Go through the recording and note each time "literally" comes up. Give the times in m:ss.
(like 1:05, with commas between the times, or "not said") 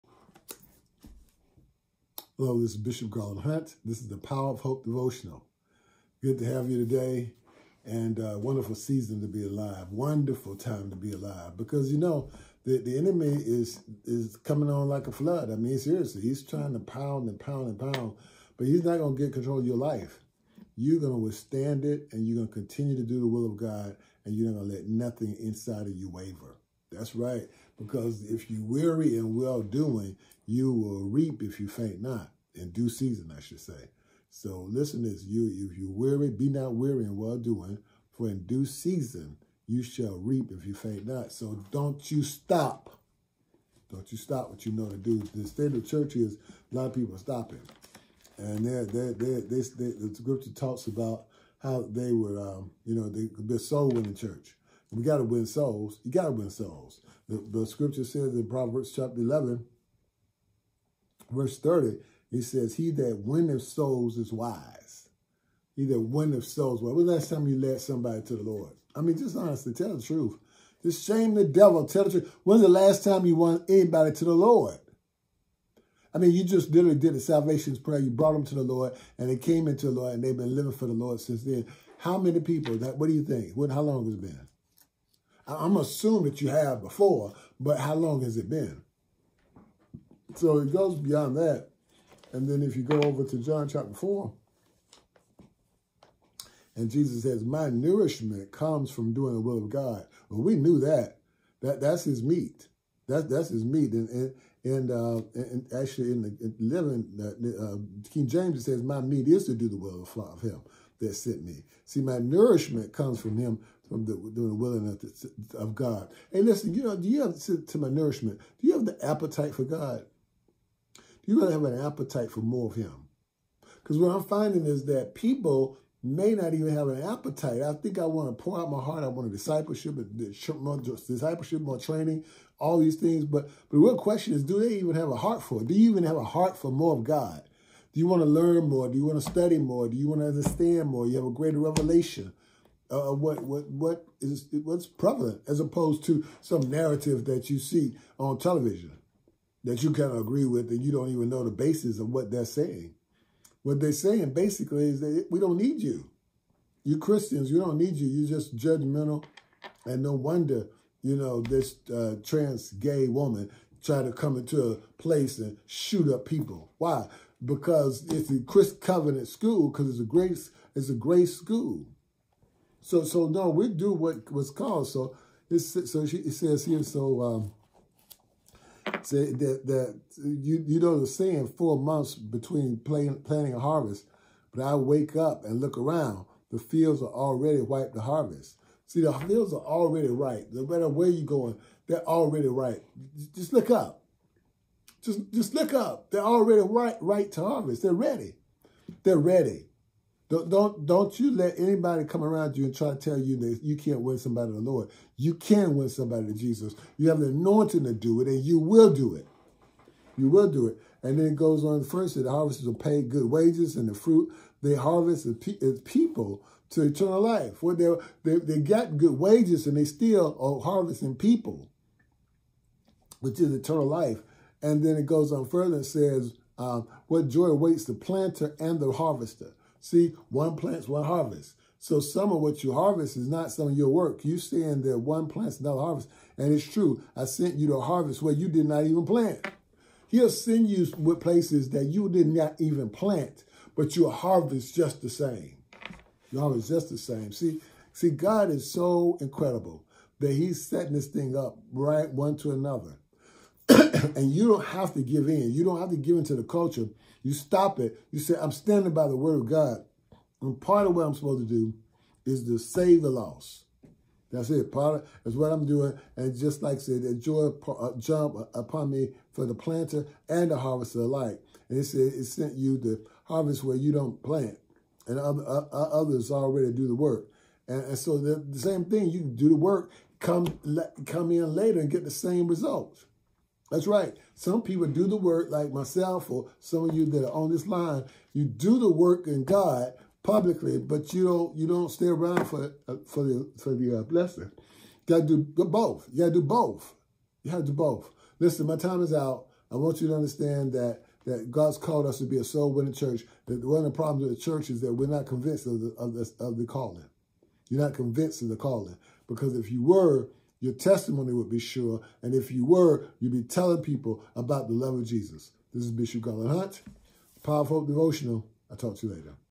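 1:16.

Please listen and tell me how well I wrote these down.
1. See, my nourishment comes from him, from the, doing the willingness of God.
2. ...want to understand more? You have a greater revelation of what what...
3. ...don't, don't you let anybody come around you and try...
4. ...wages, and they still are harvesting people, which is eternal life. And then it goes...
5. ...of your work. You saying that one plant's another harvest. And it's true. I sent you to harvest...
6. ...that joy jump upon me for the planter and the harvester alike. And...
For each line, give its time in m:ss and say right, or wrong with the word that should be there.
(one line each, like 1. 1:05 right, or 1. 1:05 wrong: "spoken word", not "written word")
1. 1:51 right
2. 2:20 right
3. 3:20 right
4. 3:39 right
5. 3:53 right
6. 4:27 right.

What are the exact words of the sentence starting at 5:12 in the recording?
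And if you were, you'd be telling people about the love of Jesus.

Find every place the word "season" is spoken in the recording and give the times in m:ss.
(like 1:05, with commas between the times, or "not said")
0:08, 0:32, 0:38.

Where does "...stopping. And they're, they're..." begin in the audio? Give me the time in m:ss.
0:47.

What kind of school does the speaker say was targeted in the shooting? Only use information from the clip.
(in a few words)
Covenant school.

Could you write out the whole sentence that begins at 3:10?
No matter where you're going, they're already ripe.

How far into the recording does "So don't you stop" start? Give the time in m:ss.
0:41.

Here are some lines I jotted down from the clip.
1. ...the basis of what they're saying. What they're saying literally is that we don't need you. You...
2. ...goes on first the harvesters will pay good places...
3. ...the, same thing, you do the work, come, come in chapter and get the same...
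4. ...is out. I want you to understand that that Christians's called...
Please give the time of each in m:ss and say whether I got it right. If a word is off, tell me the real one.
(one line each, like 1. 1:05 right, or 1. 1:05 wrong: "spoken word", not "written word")
1. 2:31 wrong: "basically", not "literally"
2. 3:31 wrong: "wages", not "places"
3. 4:38 wrong: "later", not "chapter"
4. 4:59 wrong: "God", not "Christians".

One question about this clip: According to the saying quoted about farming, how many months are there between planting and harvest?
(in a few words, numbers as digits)
4.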